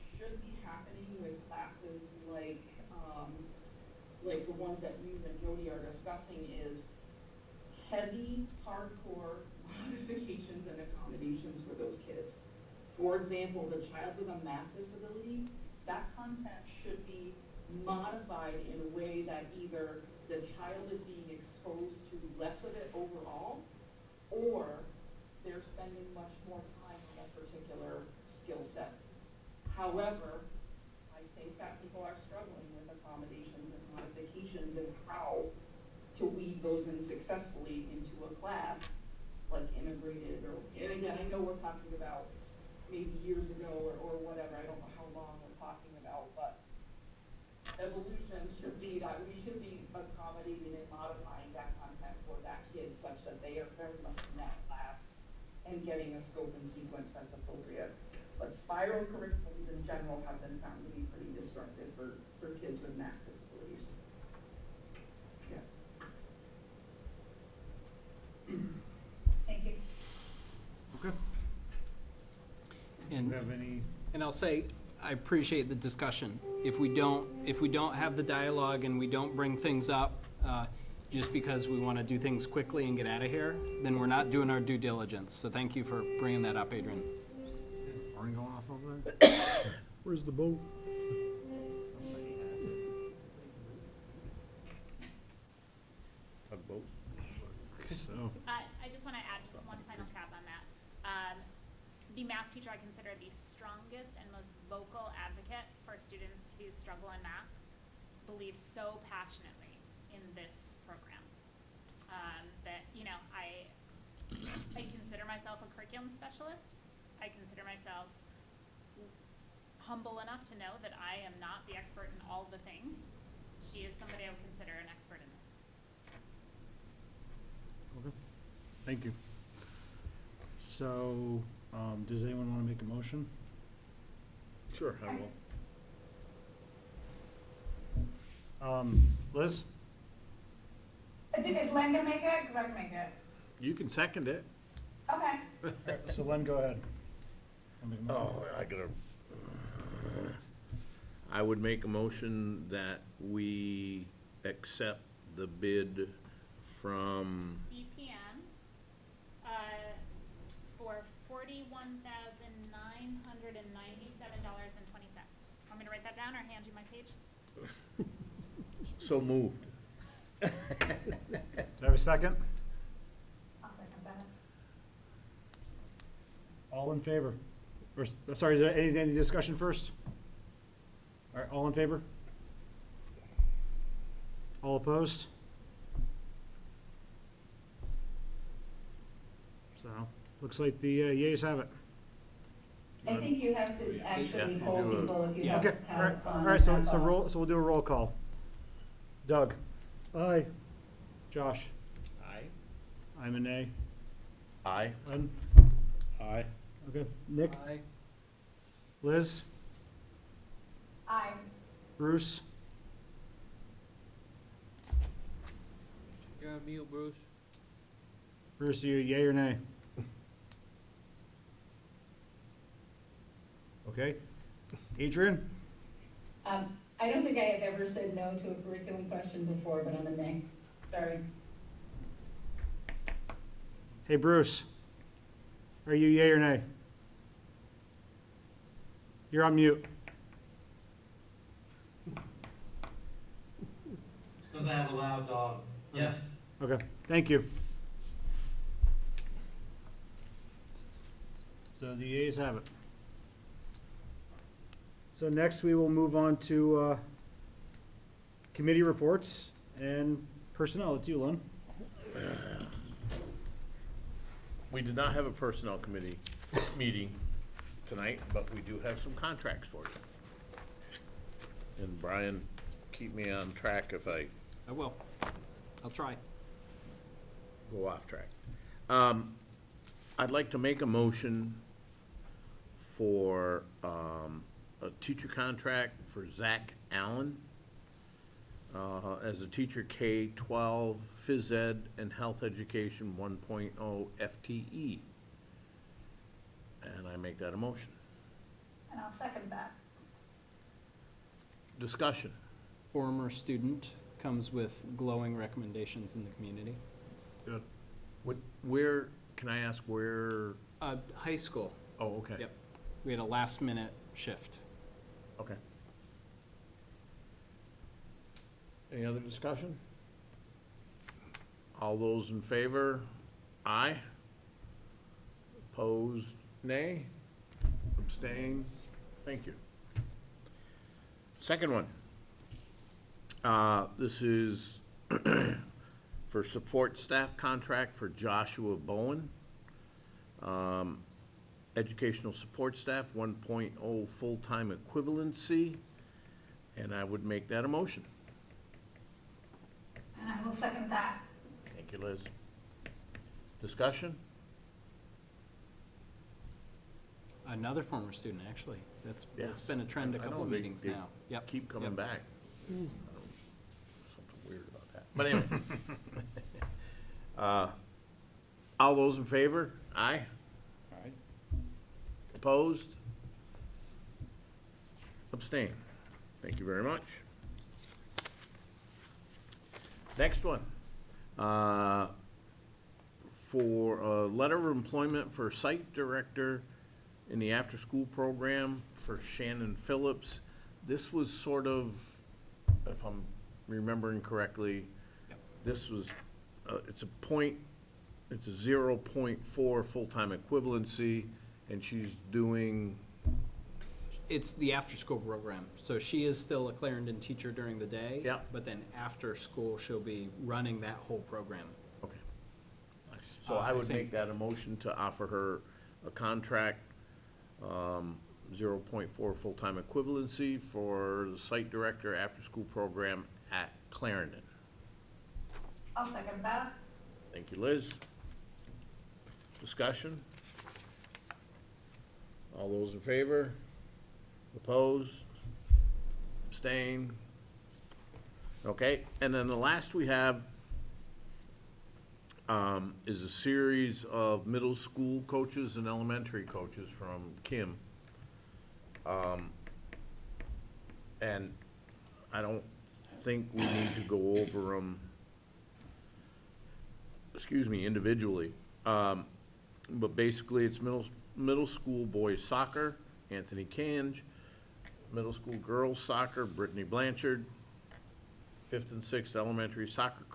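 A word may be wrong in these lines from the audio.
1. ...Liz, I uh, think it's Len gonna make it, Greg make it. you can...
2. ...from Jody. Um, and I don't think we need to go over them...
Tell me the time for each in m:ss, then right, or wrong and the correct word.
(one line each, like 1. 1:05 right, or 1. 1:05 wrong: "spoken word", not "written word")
1. 2:19 right
2. 7:26 wrong: "Kim", not "Jody".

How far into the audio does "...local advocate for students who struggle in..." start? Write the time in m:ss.
1:44.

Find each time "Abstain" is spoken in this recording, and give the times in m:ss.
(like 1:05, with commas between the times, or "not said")
5:27, 6:15, 7:16.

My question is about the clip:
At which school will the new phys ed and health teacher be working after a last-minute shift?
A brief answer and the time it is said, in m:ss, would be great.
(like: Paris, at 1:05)
High school, at 5:11.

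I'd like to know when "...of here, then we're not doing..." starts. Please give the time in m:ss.
1:23.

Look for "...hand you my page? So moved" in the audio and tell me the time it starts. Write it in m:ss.
2:46.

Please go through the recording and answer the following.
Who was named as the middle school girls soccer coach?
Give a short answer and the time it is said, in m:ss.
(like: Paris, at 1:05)
Brittany Blanchard, at 7:46.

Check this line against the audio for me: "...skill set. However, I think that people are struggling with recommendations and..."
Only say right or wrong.
wrong.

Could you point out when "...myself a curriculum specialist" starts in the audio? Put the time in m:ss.
1:55.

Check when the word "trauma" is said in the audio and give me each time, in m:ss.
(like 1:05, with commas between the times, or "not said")
not said.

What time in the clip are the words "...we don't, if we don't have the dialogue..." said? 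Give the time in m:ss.
1:16.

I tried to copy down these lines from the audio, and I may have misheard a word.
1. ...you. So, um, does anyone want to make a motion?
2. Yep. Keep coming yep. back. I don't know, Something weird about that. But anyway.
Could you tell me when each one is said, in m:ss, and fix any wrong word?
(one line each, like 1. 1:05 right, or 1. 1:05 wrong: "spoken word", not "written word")
1. 2:09 right
2. 6:01 right.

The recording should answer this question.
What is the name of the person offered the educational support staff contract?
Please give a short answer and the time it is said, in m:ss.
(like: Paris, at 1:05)
Joshua Bowen, at 5:38.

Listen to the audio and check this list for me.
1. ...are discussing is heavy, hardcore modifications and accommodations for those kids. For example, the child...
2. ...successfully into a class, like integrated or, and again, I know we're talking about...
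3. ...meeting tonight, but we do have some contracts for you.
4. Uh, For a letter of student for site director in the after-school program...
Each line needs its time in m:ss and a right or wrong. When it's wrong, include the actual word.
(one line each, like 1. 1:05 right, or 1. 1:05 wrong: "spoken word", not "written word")
1. 0:05 right
2. 0:37 right
3. 4:26 right
4. 6:21 wrong: "employment", not "student".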